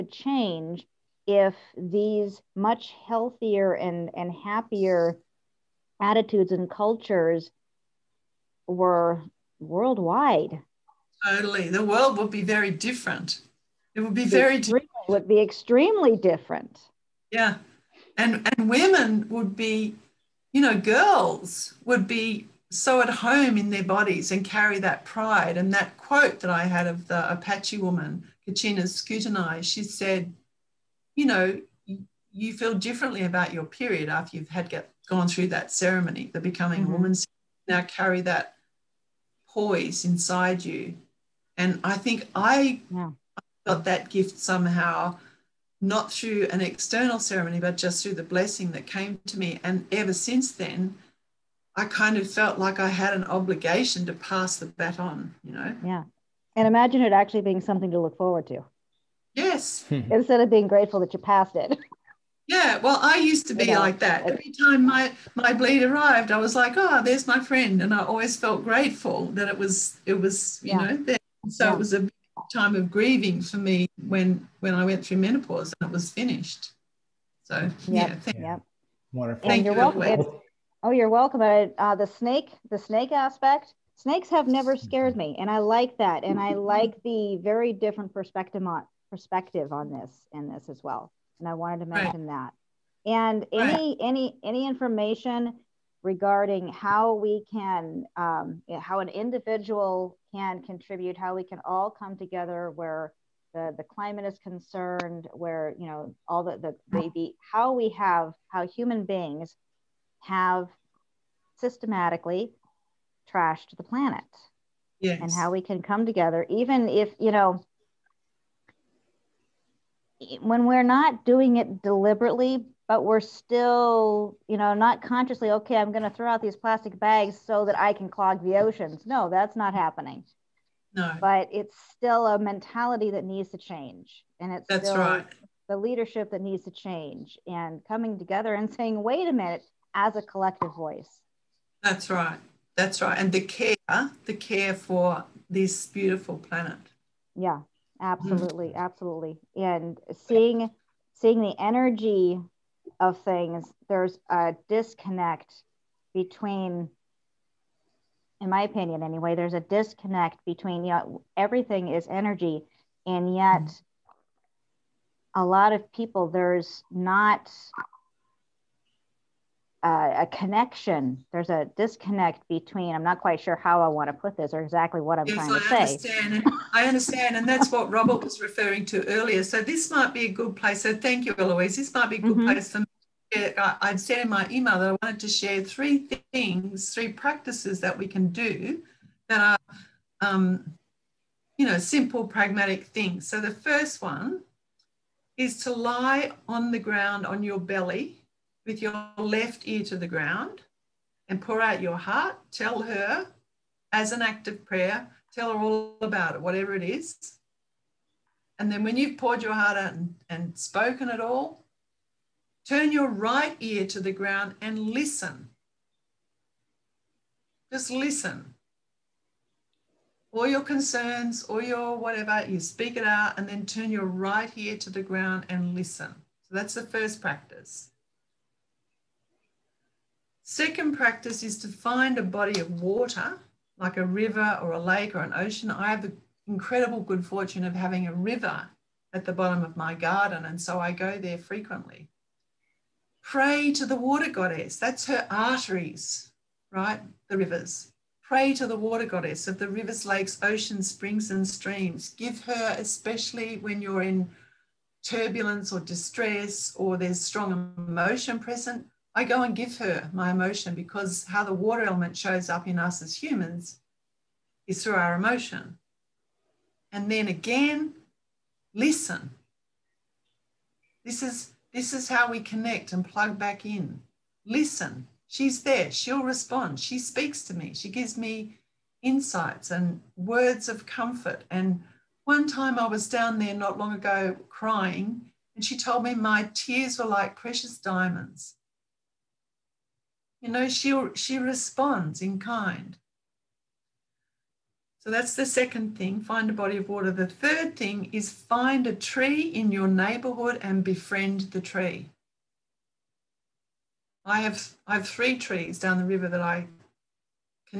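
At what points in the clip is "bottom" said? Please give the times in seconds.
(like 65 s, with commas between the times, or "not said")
239 s.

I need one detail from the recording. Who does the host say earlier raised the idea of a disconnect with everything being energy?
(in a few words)
Robert.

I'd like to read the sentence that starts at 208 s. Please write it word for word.
And then when you've poured your heart out and, and spoken it all, turn your right ear to the ground and listen.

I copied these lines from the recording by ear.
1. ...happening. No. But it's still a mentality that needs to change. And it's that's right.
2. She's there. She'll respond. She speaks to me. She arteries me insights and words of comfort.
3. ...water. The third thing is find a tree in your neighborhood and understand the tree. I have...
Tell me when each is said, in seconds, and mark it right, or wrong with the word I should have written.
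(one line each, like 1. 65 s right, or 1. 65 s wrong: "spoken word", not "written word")
1. 129 s right
2. 275 s wrong: "gives", not "arteries"
3. 296 s wrong: "befriend", not "understand".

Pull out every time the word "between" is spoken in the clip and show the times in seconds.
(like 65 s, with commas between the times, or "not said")
156 s, 160 s, 172 s.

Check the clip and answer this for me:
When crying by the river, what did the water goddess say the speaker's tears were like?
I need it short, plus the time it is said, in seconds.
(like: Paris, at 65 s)
Precious diamonds, at 287 s.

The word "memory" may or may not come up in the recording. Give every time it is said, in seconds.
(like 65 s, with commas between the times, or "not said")
not said.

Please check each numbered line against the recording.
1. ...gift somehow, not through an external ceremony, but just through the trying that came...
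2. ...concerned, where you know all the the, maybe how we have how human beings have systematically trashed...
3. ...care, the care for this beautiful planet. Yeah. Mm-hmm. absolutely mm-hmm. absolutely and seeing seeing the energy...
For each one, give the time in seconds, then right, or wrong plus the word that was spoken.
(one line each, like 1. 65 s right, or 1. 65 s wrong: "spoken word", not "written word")
1. 44 s wrong: "blessing", not "trying"
2. 104 s right
3. 143 s right.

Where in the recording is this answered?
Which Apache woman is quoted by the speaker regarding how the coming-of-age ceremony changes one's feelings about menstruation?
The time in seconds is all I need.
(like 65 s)
28 s.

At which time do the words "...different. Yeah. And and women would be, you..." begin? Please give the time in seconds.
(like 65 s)
16 s.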